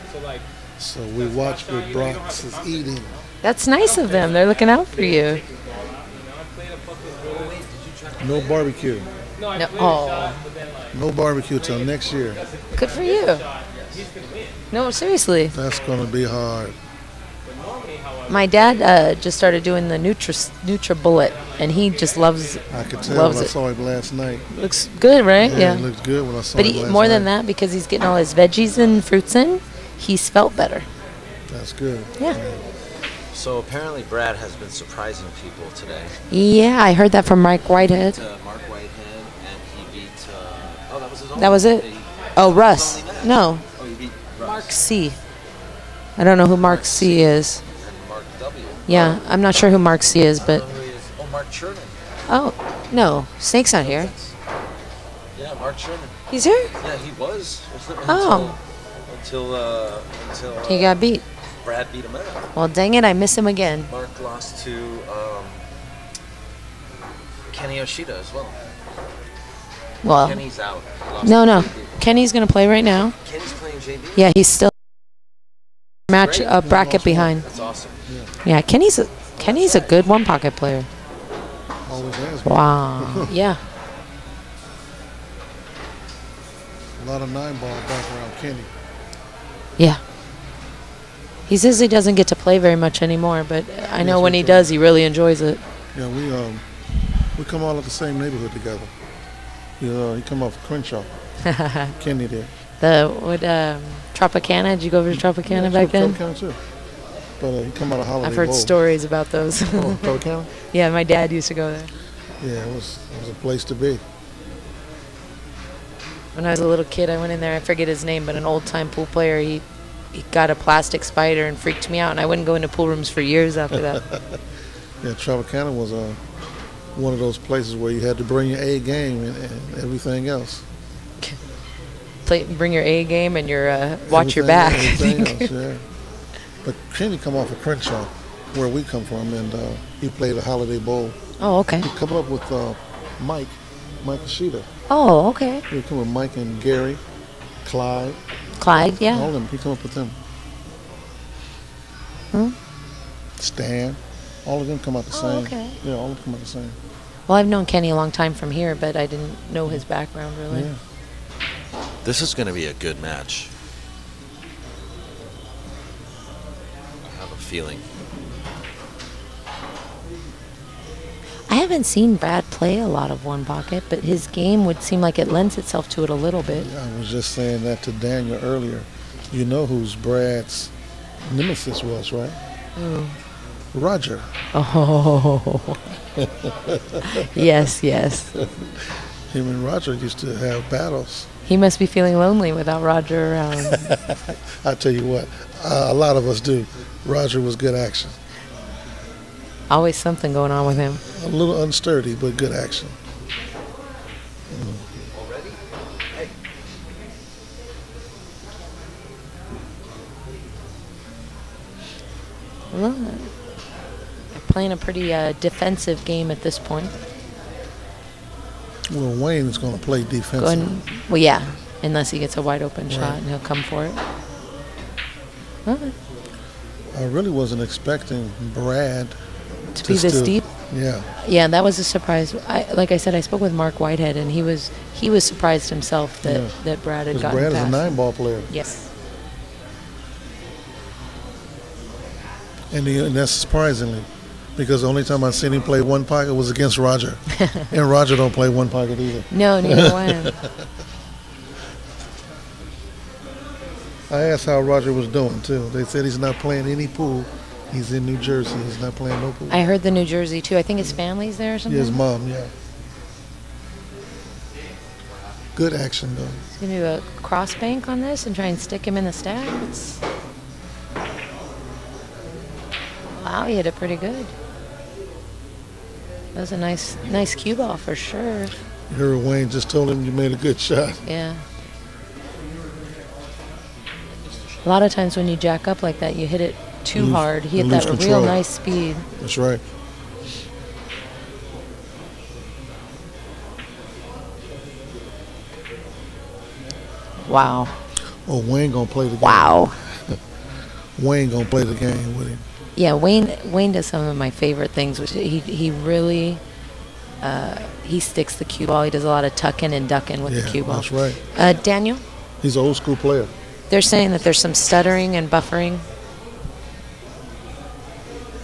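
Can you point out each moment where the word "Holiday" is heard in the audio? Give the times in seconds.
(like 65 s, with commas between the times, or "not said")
108 s, 140 s.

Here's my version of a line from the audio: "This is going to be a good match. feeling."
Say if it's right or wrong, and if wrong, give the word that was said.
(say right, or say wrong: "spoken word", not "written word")
right.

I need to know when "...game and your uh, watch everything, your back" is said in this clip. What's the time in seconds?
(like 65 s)
133 s.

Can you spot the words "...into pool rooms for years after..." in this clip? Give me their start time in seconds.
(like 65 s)
122 s.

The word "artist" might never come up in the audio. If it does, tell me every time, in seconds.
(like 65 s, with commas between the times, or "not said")
not said.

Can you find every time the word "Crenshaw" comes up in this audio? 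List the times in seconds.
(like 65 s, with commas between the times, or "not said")
100 s, 137 s.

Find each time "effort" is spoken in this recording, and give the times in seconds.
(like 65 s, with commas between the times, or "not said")
not said.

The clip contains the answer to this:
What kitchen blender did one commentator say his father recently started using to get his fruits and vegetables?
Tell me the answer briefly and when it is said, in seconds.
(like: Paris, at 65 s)
NutriBullet, at 19 s.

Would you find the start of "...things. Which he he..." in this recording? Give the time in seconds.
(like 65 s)
304 s.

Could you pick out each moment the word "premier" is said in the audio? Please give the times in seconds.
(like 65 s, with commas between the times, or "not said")
not said.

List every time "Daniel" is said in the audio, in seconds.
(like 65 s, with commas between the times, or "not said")
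177 s, 311 s.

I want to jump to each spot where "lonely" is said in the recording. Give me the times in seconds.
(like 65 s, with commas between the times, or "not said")
192 s.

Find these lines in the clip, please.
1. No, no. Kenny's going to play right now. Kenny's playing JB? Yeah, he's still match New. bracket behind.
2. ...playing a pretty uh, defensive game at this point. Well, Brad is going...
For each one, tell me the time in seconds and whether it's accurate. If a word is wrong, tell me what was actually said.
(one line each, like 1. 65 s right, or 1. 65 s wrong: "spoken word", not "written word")
1. 71 s wrong: "Great", not "New"
2. 214 s wrong: "Wayne", not "Brad".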